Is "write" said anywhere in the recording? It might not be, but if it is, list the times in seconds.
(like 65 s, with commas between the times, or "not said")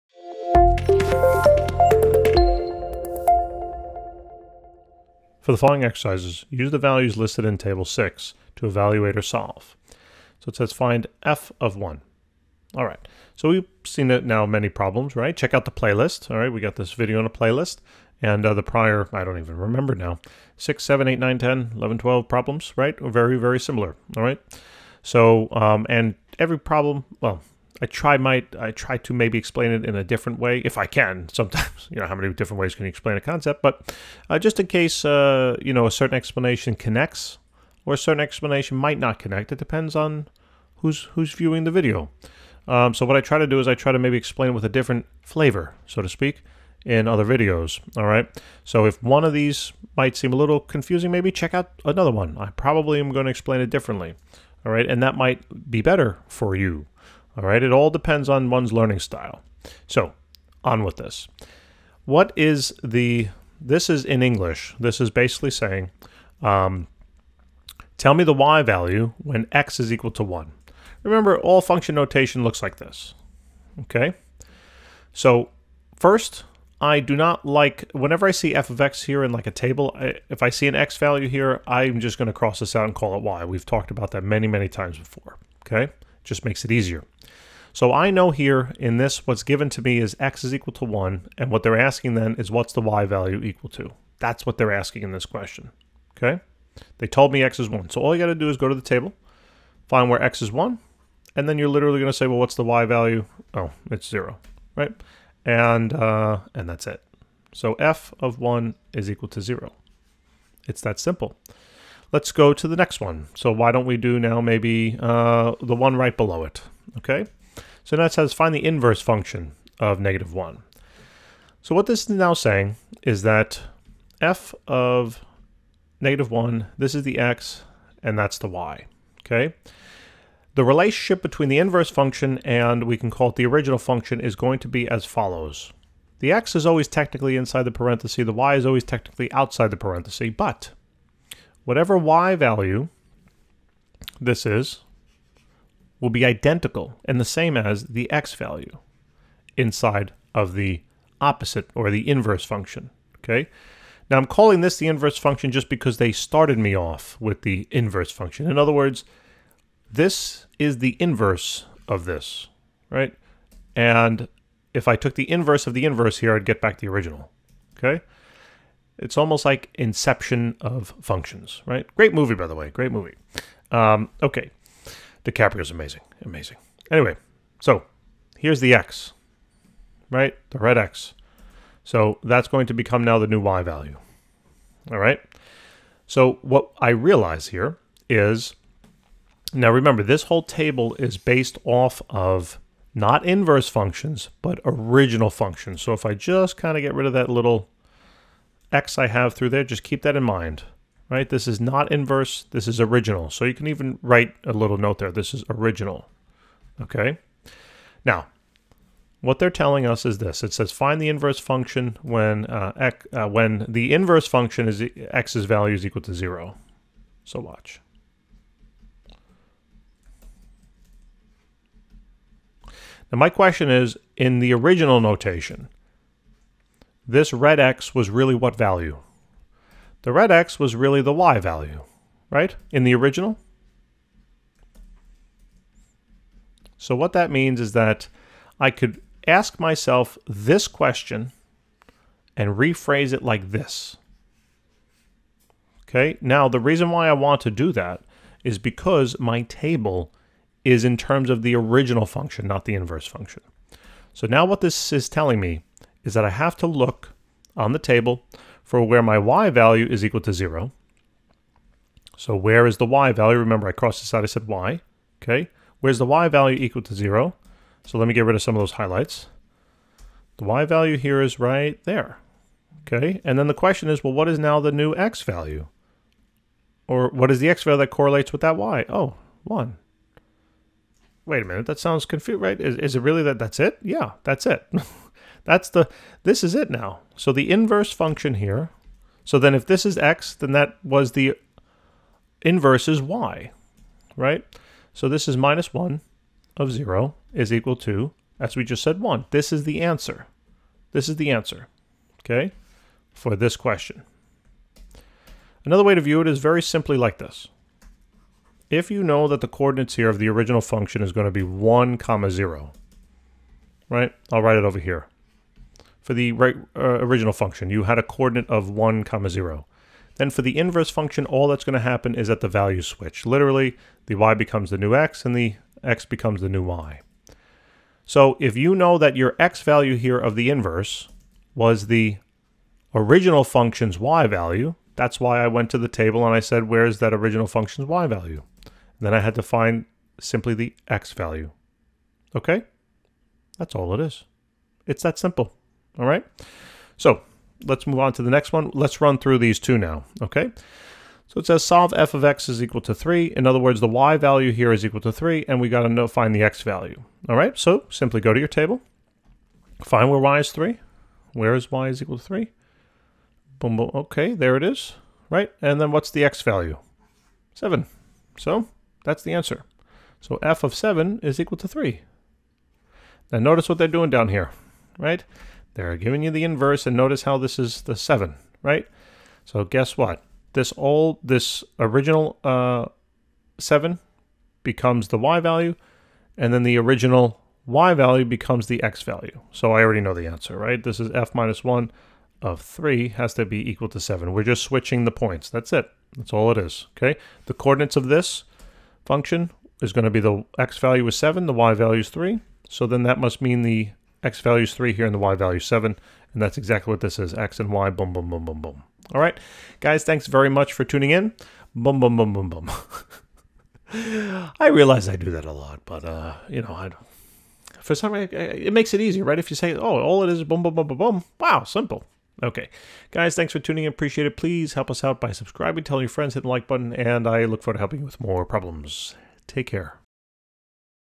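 204 s, 314 s.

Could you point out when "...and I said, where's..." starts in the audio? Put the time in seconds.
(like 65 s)
336 s.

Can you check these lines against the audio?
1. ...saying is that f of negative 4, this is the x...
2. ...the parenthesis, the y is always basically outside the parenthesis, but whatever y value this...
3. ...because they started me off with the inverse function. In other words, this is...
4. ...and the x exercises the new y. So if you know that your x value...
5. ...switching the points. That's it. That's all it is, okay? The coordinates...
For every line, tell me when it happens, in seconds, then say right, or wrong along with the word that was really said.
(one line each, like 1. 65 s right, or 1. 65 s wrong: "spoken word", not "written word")
1. 122 s wrong: "1", not "4"
2. 137 s wrong: "technically", not "basically"
3. 155 s right
4. 325 s wrong: "becomes", not "exercises"
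5. 394 s right.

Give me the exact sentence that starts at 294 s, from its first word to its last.
So this is minus 1 of 0 is equal to, as we just said, 1.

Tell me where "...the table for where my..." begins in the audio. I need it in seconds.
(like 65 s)
257 s.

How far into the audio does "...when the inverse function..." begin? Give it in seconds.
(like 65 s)
213 s.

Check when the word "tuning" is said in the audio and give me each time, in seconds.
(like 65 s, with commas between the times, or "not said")
410 s, 423 s.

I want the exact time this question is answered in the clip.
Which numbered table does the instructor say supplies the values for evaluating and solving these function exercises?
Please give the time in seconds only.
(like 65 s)
7 s.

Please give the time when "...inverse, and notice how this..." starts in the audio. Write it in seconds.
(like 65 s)
376 s.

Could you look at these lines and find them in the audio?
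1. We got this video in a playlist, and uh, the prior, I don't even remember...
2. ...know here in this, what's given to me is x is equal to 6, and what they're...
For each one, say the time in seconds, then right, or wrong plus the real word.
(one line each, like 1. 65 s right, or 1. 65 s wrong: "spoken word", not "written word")
1. 16 s right
2. 88 s wrong: "1", not "6".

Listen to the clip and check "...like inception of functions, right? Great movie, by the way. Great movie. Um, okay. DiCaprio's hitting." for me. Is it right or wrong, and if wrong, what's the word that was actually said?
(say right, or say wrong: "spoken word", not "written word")
wrong: "amazing", not "hitting".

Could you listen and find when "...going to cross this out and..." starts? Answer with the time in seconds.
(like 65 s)
82 s.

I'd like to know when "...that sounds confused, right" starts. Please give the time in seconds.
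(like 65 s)
281 s.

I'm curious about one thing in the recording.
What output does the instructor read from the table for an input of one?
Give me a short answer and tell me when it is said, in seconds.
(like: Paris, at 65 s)
0, at 103 s.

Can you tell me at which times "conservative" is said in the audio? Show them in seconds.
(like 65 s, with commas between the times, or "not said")
not said.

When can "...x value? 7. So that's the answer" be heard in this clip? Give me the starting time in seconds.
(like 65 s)
366 s.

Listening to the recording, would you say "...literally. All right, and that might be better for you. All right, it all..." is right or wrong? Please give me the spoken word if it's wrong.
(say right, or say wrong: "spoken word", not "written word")
wrong: "differently", not "literally".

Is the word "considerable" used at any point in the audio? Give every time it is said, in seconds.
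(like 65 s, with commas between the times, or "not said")
not said.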